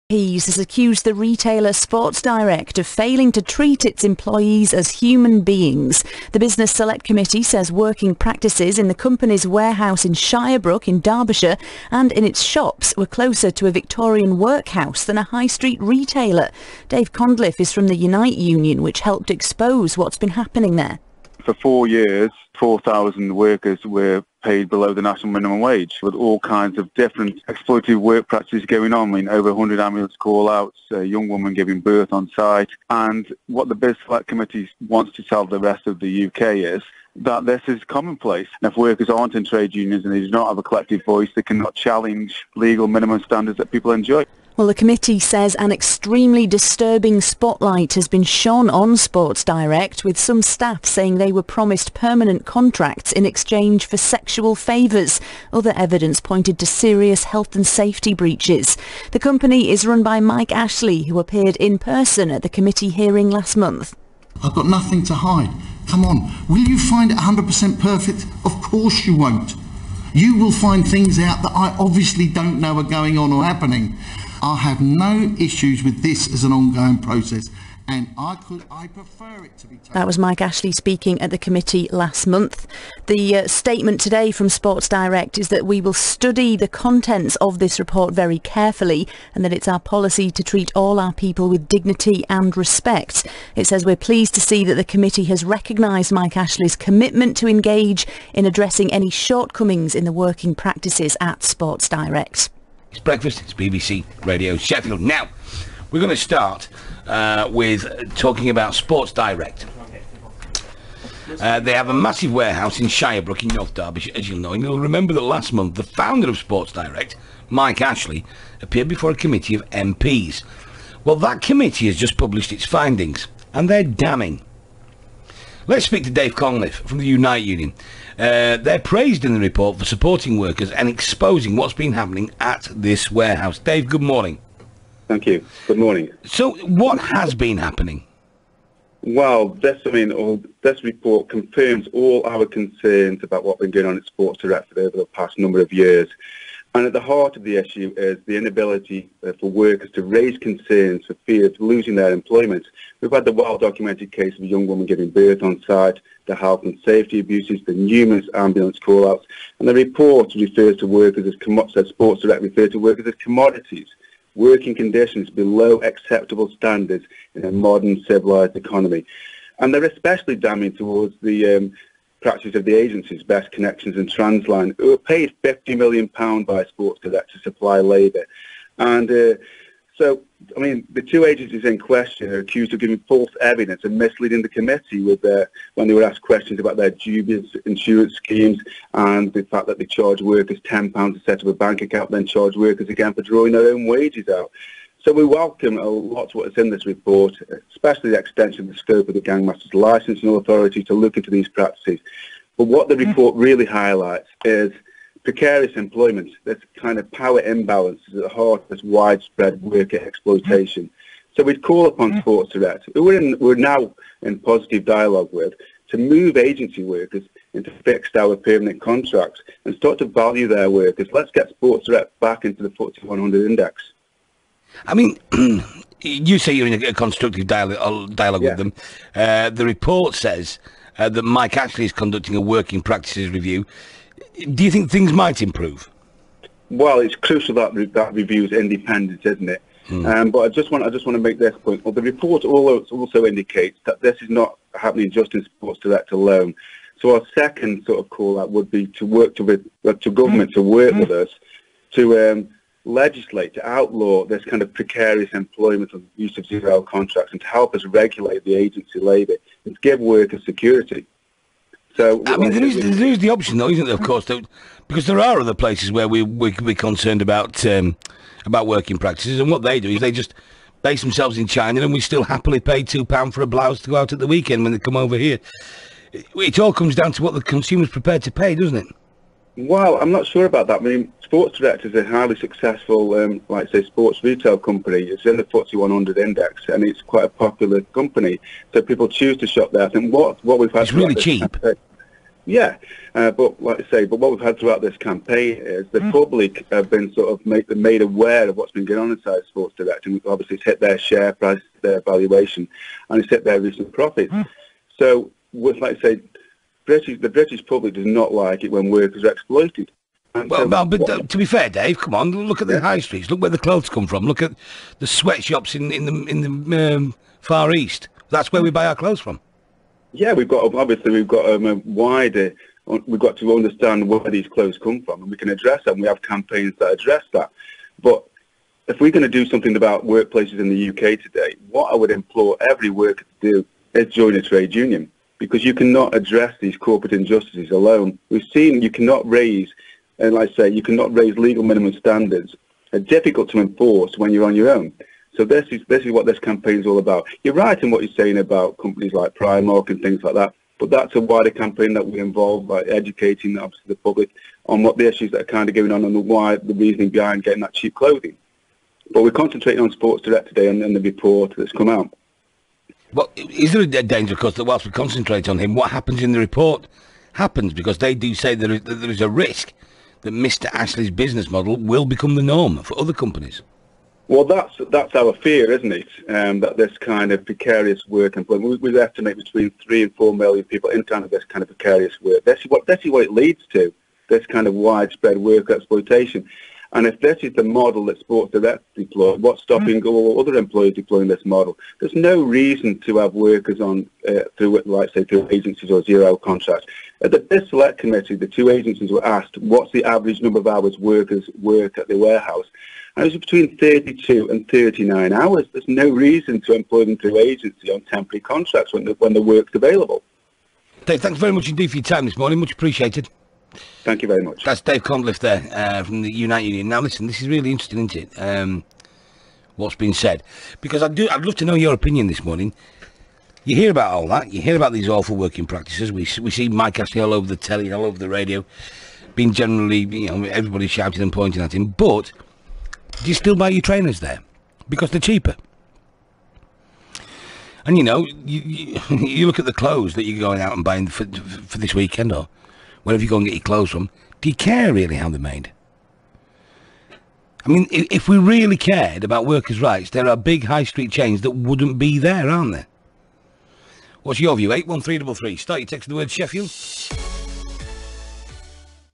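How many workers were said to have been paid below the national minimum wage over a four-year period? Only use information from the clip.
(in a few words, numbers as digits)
4,000.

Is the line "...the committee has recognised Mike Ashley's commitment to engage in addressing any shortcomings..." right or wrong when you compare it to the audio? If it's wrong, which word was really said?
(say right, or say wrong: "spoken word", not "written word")
right.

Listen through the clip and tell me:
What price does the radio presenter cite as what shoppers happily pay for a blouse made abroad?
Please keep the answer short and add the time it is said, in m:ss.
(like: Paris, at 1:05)
£2, at 4:32.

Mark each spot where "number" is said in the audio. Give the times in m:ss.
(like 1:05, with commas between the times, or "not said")
2:25, 6:40.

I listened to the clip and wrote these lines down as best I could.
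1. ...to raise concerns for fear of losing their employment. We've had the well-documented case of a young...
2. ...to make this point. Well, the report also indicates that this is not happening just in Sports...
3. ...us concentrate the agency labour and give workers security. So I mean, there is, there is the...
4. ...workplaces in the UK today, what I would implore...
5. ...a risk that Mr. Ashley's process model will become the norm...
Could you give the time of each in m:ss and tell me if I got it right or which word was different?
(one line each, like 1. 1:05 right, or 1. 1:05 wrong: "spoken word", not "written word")
1. 2:29 right
2. 4:01 right
3. 4:17 wrong: "regulate", not "concentrate"
4. 5:30 right
5. 6:09 wrong: "business", not "process".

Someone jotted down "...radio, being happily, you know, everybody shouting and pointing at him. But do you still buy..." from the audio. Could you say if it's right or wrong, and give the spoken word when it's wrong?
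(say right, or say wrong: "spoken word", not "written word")
wrong: "generally", not "happily".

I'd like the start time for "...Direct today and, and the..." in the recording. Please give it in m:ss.
6:00.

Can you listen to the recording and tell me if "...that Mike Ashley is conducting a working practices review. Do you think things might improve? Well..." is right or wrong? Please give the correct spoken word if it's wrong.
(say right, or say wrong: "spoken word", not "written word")
right.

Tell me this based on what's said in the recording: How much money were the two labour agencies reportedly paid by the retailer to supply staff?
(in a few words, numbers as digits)
£50 million.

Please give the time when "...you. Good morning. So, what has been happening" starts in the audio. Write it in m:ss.
2:15.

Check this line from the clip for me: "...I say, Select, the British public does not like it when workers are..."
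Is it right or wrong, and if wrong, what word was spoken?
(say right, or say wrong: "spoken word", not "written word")
wrong: "British", not "Select".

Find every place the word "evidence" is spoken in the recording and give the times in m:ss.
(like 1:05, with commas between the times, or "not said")
0:55, 3:03.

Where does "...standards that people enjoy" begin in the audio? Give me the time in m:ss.
0:43.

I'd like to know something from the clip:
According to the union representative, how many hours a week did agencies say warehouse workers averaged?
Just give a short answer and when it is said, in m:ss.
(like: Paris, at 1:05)
32 to 39 hours, at 6:43.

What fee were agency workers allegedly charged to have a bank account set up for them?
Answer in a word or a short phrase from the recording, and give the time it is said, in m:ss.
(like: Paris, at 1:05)
£10, at 3:10.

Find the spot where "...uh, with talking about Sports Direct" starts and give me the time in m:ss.
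1:47.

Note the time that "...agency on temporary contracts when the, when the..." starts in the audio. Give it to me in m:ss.
6:47.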